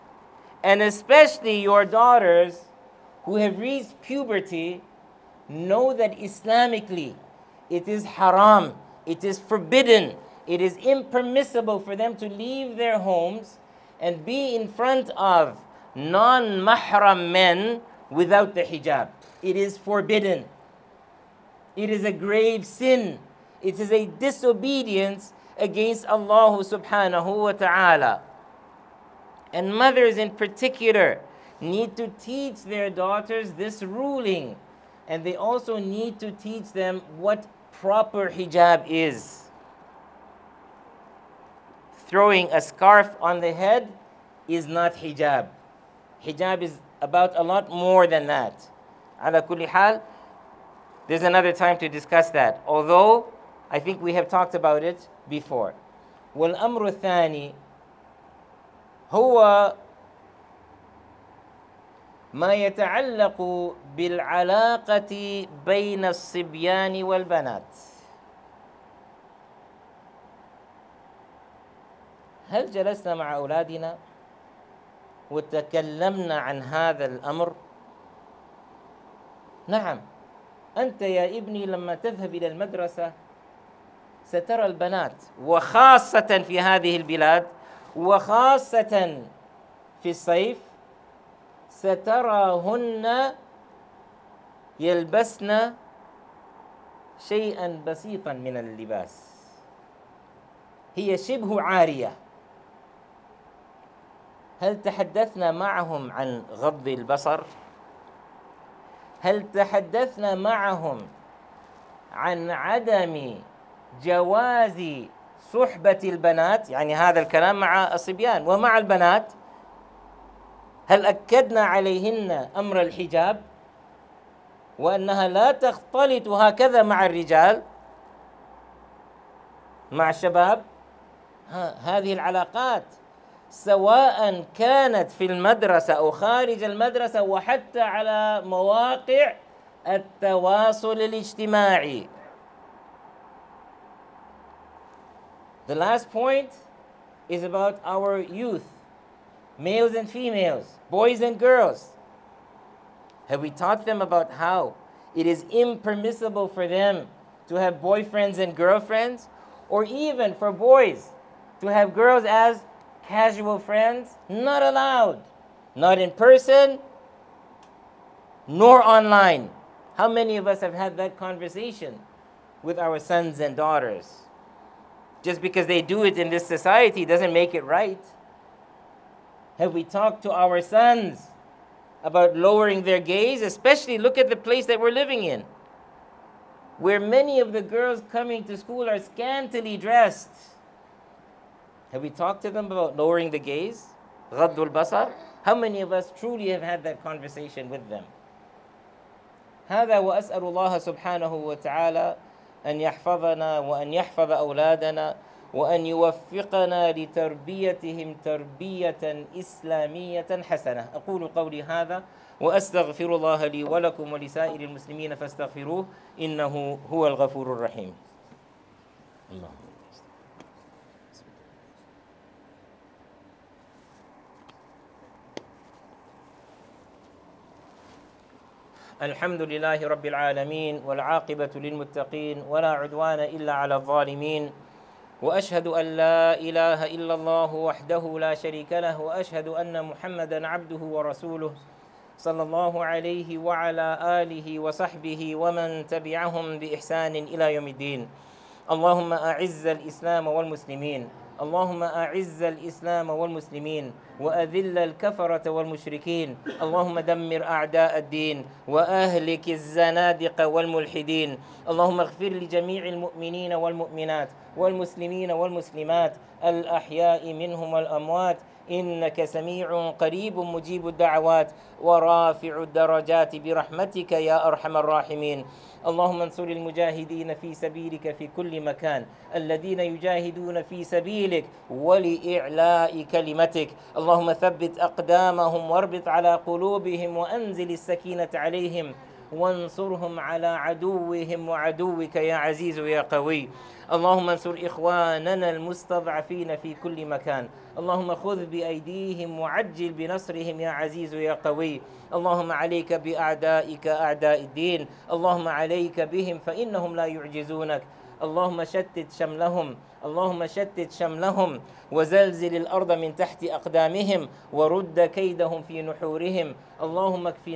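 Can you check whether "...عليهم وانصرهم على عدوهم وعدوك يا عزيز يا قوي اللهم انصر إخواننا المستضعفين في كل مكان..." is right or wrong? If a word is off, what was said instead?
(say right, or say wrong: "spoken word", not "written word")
right.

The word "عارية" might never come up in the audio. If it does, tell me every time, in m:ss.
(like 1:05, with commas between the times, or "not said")
1:41.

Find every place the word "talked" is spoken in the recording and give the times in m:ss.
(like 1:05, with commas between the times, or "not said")
0:54, 2:59, 3:12.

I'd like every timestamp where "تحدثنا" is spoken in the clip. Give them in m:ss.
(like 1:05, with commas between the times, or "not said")
1:44, 1:49.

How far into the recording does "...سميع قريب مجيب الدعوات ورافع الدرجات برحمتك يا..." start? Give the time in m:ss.
4:29.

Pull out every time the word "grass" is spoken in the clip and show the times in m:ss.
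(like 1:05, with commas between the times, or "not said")
not said.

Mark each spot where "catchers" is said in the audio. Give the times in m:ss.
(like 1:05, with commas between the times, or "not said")
not said.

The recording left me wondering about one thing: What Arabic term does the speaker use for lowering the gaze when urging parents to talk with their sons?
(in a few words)
Ghaddul basar.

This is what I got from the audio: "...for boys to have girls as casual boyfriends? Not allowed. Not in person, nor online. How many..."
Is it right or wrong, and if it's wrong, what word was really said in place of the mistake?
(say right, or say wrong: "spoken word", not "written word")
wrong: "friends", not "boyfriends".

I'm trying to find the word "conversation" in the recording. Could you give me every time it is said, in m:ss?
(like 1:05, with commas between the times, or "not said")
2:51, 3:17.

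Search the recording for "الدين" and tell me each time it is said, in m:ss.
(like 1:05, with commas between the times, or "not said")
4:07, 4:17, 5:04.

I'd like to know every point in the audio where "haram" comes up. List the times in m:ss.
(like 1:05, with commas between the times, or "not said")
0:08.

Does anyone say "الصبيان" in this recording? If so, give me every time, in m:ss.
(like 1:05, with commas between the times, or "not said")
1:06, 1:57.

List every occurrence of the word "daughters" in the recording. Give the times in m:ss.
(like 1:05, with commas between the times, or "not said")
0:01, 0:32, 2:53.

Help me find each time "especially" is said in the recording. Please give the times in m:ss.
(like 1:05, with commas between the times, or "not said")
0:00, 3:03.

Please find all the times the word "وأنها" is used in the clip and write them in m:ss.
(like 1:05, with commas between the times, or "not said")
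2:04.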